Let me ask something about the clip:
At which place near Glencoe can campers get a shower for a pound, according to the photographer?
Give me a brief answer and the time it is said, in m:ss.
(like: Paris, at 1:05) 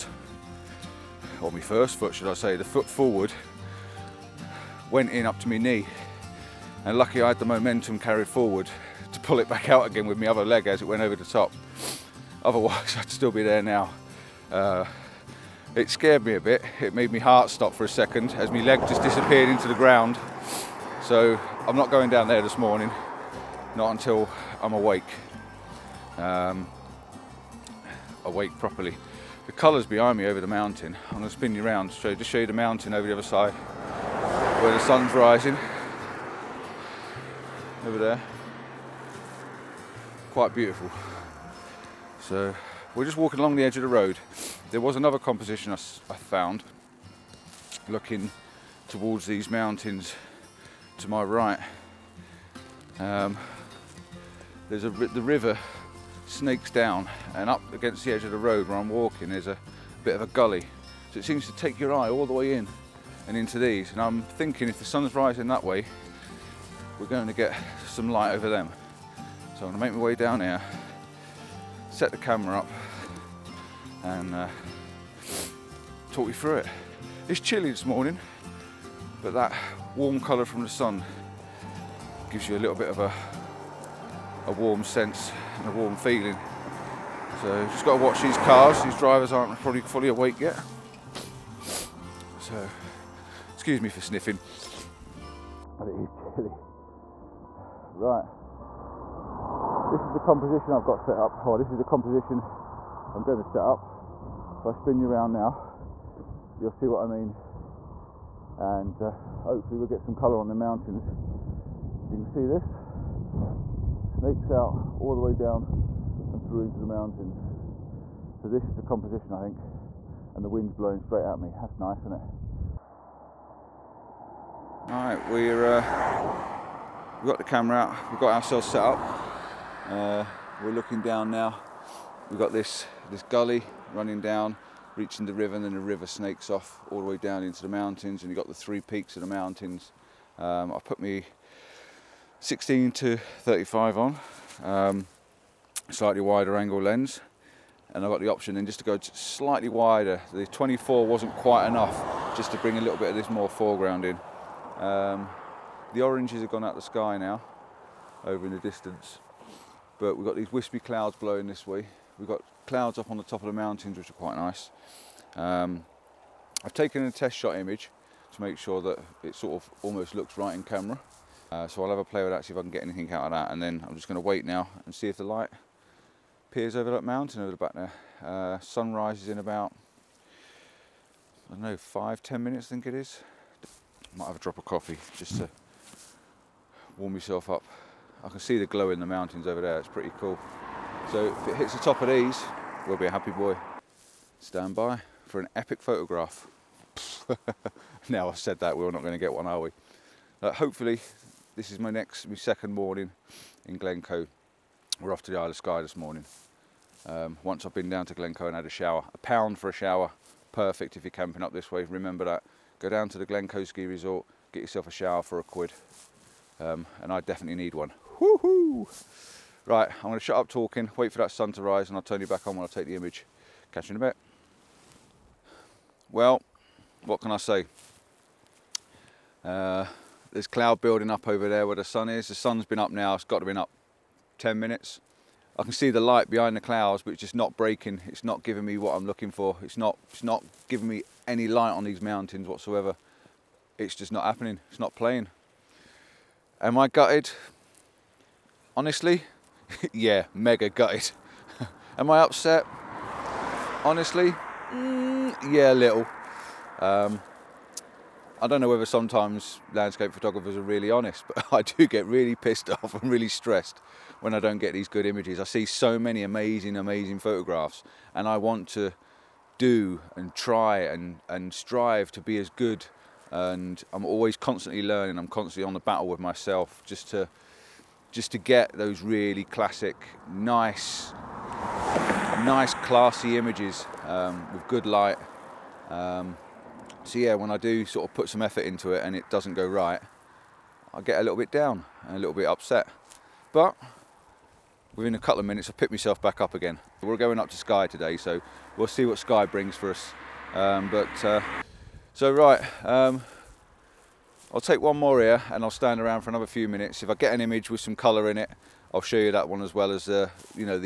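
Glencoe Ski Resort, at 3:33.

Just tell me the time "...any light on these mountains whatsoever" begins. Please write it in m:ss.
4:01.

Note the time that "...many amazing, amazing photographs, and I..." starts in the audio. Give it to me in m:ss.
4:25.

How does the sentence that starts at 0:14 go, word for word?
Uh, it scared me a bit, it made my heart stop for a second as my leg just disappeared into the ground.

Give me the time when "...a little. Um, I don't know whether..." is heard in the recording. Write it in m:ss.
4:15.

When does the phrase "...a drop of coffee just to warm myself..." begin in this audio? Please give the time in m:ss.
3:04.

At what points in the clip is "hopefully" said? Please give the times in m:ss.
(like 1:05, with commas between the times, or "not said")
1:49, 3:20.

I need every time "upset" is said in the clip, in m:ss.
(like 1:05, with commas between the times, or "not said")
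4:12, 4:52.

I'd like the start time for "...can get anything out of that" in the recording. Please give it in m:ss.
2:52.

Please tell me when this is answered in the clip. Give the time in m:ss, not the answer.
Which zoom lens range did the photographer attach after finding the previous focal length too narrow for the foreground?
2:22.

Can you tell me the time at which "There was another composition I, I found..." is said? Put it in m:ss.
0:44.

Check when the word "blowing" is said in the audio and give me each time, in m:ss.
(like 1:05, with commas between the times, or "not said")
2:00, 2:41.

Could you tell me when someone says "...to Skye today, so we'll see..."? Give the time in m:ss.
4:57.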